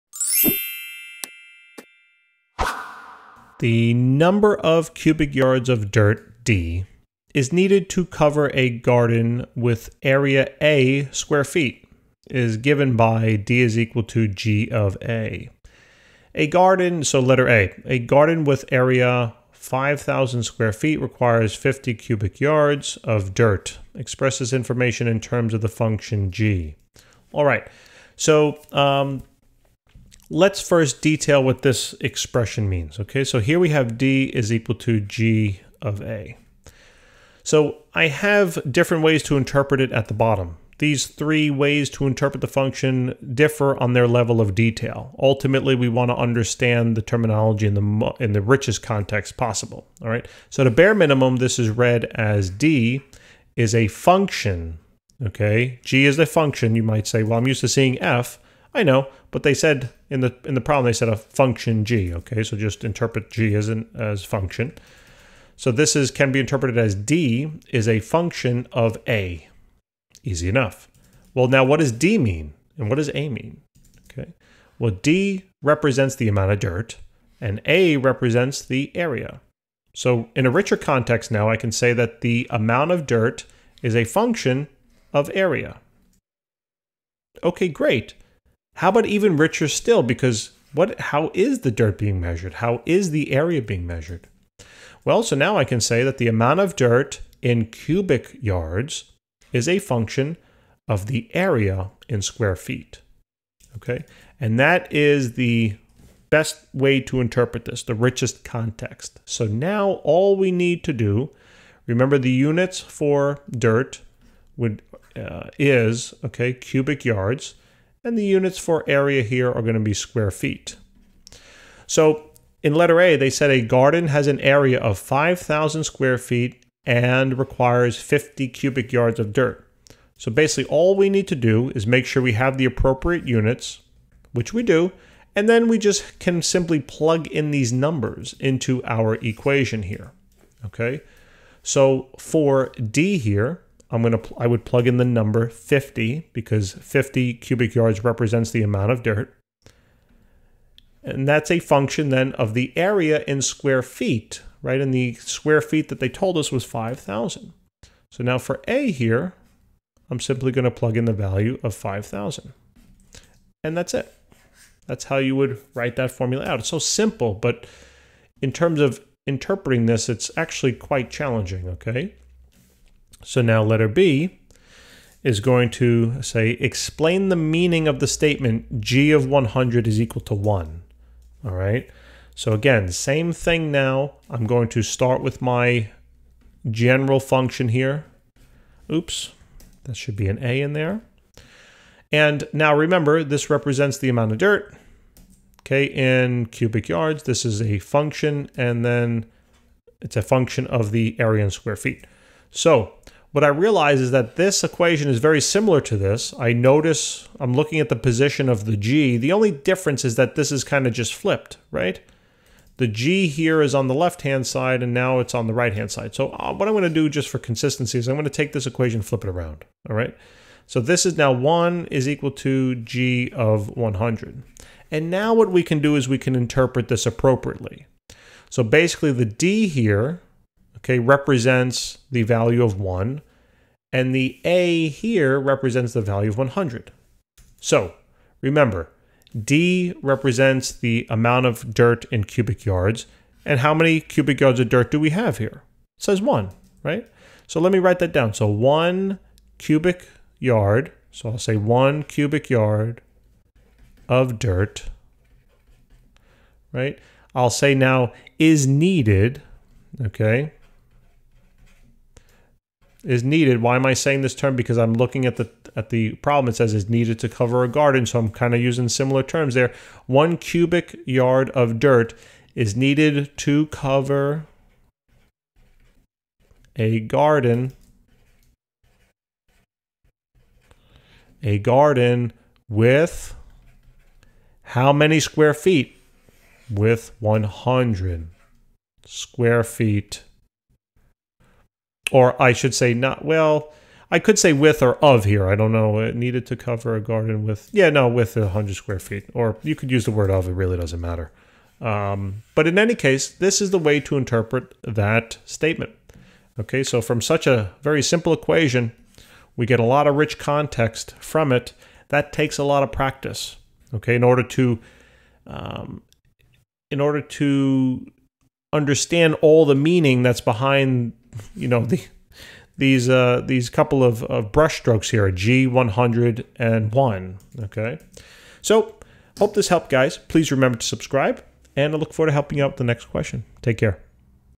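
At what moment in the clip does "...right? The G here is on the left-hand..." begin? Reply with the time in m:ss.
3:31.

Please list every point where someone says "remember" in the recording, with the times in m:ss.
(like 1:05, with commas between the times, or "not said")
1:51, 3:12, 3:58, 5:30.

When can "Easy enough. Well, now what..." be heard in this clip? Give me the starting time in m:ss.
1:10.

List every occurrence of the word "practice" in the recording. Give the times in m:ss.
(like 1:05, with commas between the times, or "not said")
5:12.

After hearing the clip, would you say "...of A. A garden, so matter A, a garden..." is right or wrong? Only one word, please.
wrong.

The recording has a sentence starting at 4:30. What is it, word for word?
One cubic yard of dirt is needed to cover a garden.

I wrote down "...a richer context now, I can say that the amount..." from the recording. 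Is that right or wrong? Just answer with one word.
right.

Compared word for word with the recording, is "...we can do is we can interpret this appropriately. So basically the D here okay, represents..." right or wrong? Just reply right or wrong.
right.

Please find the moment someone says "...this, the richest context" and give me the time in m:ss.
1:47.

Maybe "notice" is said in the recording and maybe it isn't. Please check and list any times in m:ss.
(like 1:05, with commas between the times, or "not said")
3:26.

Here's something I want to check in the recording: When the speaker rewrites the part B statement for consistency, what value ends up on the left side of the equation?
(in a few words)
1.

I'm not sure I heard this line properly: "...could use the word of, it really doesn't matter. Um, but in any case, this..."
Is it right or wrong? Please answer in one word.
right.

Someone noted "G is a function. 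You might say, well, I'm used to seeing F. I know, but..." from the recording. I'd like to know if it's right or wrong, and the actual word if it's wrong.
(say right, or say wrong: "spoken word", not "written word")
right.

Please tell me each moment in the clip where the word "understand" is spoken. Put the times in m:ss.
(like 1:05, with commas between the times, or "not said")
0:46, 5:18.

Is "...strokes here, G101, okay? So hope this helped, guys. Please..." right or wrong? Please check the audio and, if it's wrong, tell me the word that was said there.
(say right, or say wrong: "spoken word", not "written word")
right.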